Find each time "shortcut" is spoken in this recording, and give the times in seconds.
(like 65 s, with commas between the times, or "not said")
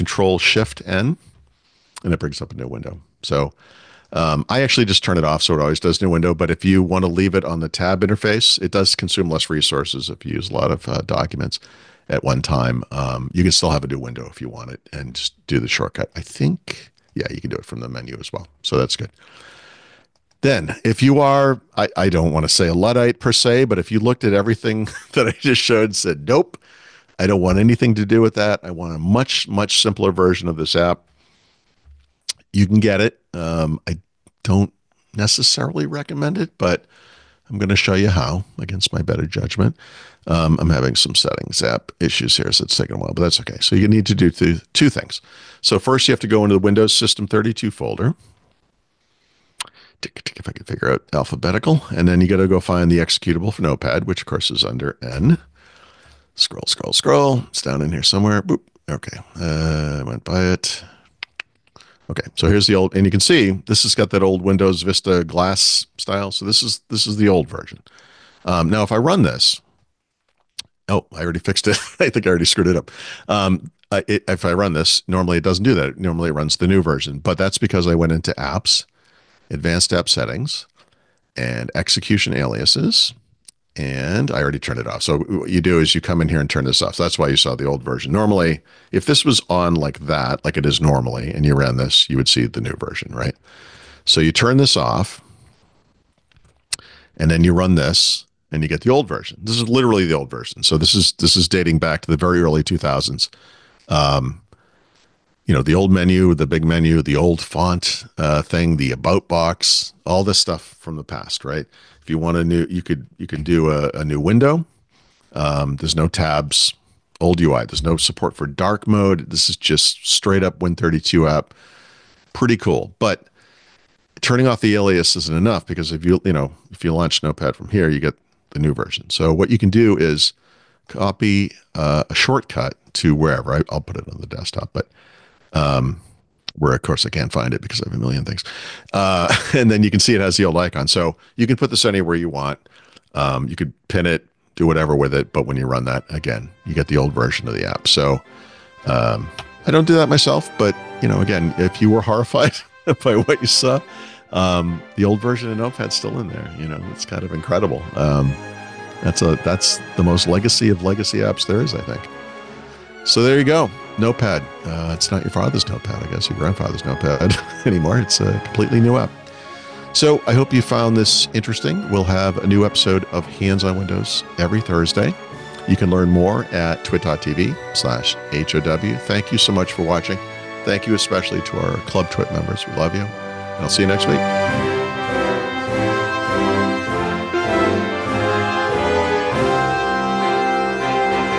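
15 s, 132 s.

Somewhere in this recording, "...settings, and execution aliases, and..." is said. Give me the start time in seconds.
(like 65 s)
80 s.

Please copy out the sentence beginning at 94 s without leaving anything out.
So you turn this off, and then you run this, and you get the old version.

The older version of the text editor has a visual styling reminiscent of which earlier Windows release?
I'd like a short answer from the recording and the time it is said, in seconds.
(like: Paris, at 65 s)
Windows Vista, at 64 s.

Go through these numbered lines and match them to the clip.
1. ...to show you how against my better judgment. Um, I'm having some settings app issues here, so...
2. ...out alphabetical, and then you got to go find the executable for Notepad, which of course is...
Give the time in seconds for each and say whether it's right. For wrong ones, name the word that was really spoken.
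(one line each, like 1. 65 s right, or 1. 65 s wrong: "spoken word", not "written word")
1. 37 s right
2. 50 s right.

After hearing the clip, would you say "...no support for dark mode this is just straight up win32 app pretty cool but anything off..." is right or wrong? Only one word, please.
wrong.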